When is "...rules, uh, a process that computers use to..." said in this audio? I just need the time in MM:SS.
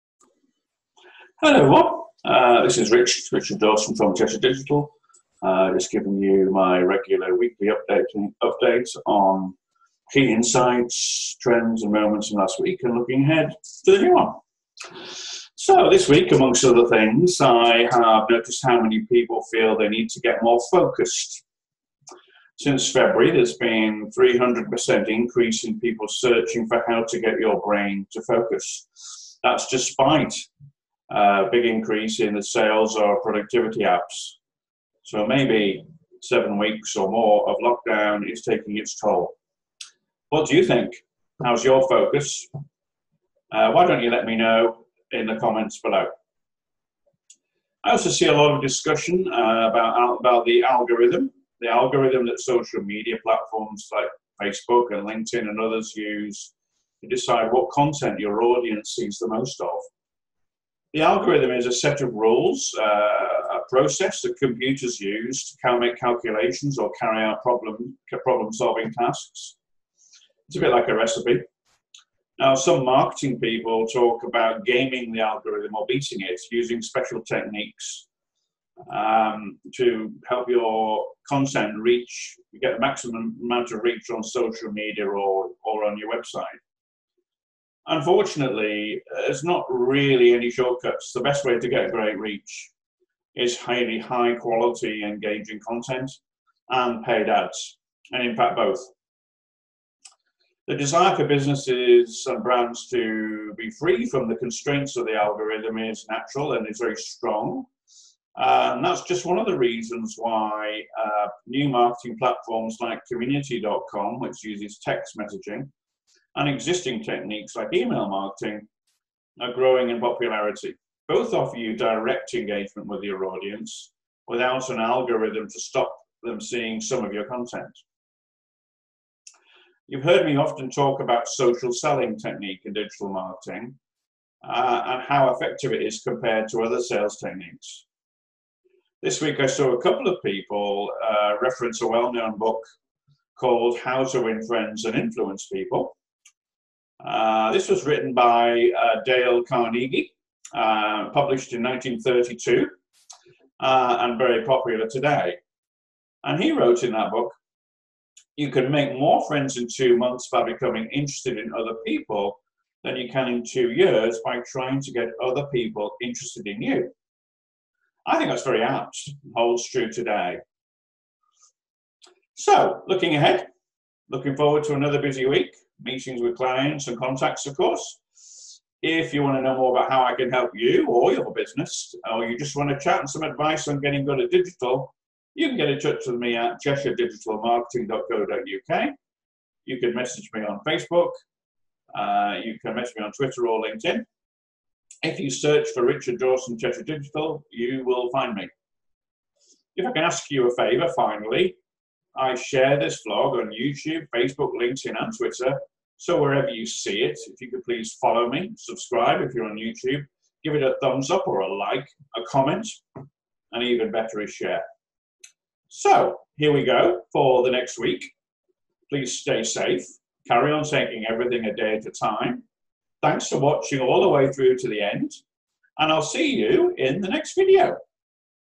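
01:02.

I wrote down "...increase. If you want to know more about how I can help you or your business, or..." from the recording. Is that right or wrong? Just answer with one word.
wrong.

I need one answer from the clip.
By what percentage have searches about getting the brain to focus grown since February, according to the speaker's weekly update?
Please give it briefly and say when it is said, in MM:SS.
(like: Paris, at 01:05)
300%, at 00:24.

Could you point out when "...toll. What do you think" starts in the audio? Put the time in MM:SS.
00:38.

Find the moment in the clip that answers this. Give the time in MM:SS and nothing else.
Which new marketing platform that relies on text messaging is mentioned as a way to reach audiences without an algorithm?
01:53.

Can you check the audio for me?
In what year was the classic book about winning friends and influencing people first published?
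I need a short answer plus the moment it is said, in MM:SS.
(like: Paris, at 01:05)
1932, at 02:31.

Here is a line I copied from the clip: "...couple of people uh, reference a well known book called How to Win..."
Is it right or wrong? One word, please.
right.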